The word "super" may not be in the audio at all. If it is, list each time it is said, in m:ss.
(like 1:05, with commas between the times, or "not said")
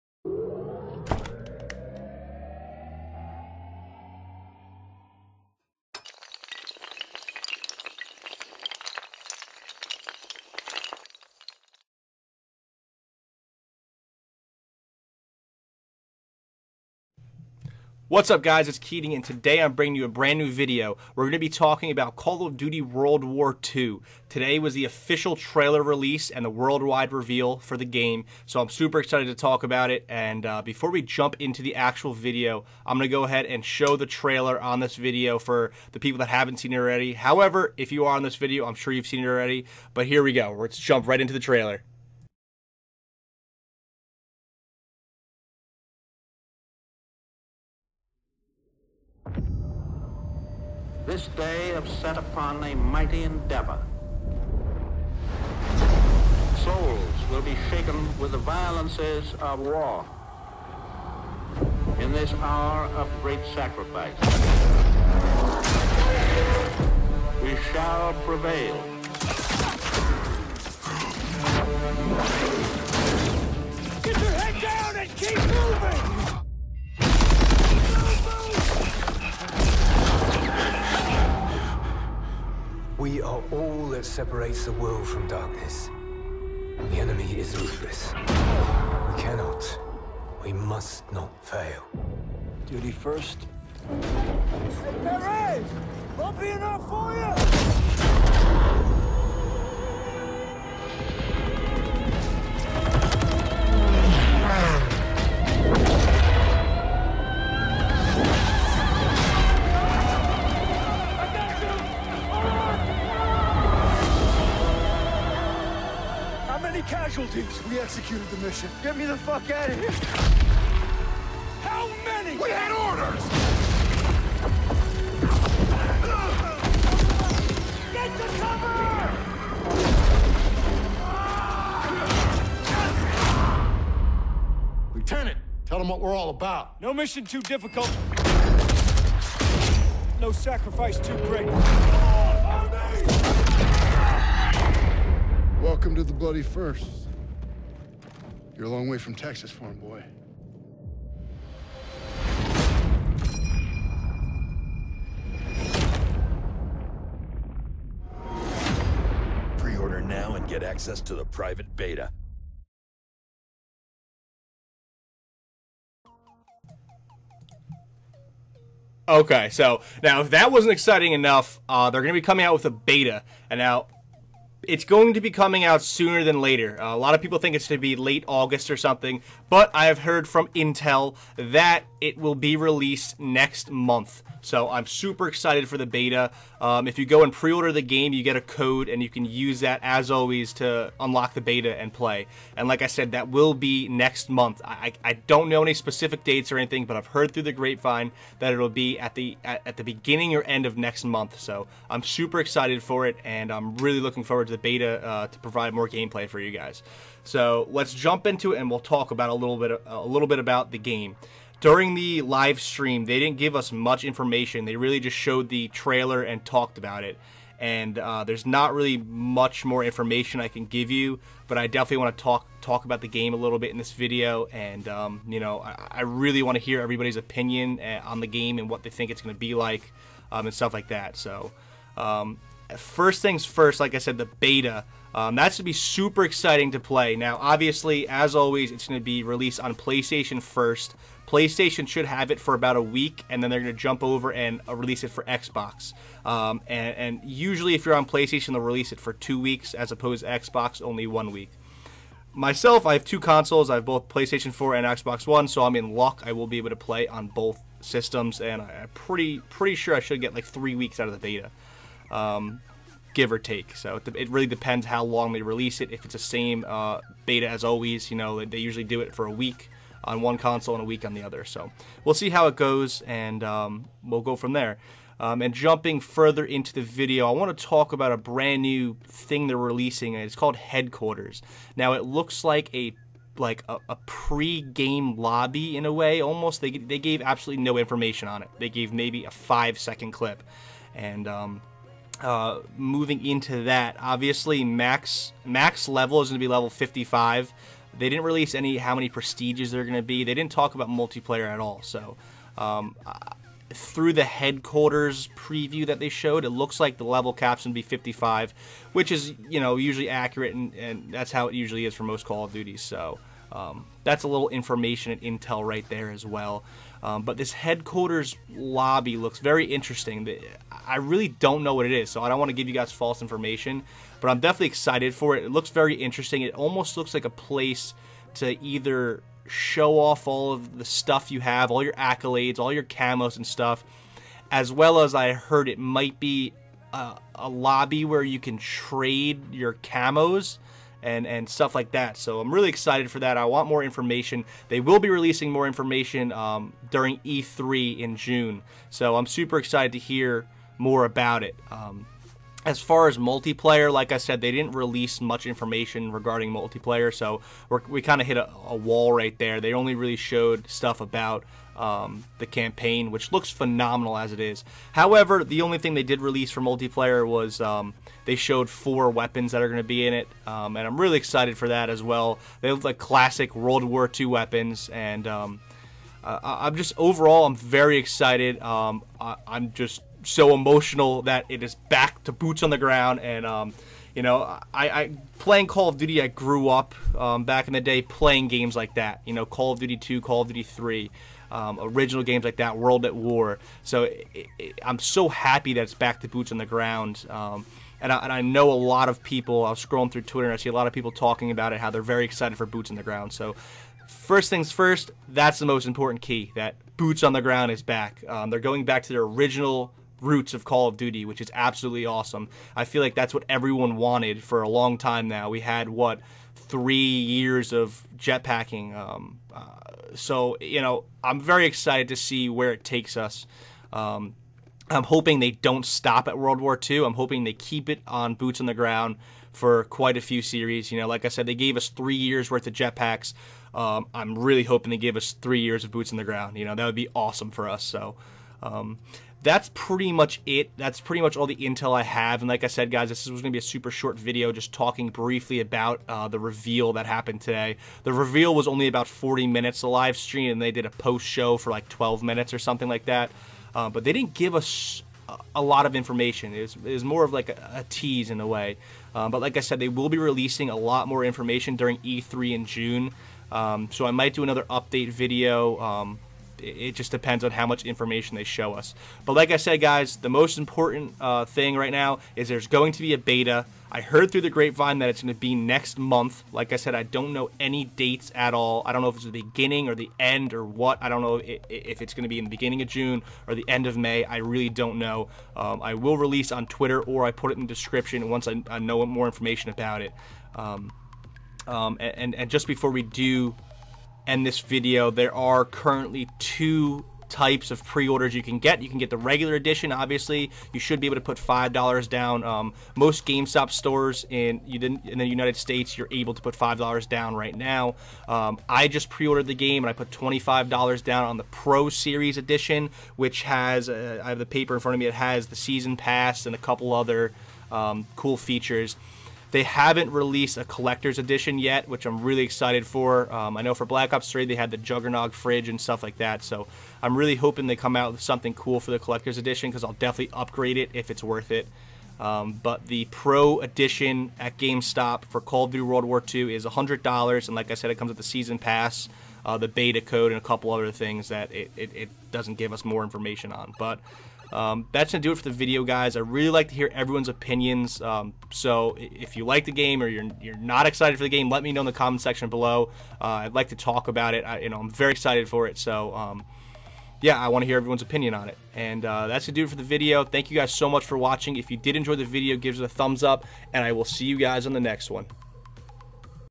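0:28, 3:04, 3:22, 3:55, 5:49, 7:23.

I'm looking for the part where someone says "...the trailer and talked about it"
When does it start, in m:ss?
3:35.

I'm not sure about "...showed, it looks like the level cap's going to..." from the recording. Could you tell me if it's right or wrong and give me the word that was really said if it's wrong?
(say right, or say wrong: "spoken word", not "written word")
right.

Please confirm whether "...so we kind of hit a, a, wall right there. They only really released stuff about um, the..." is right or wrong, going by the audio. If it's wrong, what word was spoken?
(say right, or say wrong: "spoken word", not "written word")
wrong: "showed", not "released".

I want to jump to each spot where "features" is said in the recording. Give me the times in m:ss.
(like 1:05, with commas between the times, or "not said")
8:38.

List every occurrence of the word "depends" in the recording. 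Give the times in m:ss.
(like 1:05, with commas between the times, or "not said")
4:24, 7:47.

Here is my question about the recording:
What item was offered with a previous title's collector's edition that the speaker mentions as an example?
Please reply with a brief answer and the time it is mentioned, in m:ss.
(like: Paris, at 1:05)
Juggernaut fridge, at 8:44.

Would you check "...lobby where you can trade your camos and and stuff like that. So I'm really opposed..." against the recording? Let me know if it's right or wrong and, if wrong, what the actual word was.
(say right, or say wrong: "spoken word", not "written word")
wrong: "excited", not "opposed".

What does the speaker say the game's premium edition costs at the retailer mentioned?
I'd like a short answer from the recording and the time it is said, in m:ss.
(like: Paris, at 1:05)
$100, at 8:56.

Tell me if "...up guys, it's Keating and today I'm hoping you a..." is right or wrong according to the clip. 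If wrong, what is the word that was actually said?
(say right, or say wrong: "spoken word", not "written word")
wrong: "bringing", not "hoping".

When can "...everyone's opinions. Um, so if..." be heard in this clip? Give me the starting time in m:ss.
9:06.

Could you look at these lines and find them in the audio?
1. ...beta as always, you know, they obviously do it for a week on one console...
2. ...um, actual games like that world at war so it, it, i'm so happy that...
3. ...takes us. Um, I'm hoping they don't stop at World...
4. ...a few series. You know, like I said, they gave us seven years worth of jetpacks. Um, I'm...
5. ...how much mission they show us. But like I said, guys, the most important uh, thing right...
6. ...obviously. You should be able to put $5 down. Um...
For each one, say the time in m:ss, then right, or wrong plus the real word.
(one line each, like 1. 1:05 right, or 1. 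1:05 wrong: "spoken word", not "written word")
1. 4:27 wrong: "usually", not "obviously"
2. 6:31 wrong: "original", not "actual"
3. 7:02 right
4. 7:10 wrong: "three", not "seven"
5. 7:47 wrong: "information", not "mission"
6. 8:19 right.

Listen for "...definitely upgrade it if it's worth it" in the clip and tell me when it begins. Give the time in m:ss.
8:49.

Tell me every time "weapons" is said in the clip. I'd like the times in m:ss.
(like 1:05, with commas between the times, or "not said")
6:09, 6:14.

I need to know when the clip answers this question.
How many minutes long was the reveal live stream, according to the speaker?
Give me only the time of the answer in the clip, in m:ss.
7:29.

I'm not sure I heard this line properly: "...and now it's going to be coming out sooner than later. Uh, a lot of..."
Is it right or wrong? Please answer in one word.
right.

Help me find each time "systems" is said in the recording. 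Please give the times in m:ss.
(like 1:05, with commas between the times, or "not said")
4:17.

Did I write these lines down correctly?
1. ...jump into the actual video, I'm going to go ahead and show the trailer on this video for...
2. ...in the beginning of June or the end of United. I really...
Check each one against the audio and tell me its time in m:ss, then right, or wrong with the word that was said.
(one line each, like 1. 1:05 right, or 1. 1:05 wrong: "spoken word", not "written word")
1. 0:31 right
2. 8:02 wrong: "May", not "United".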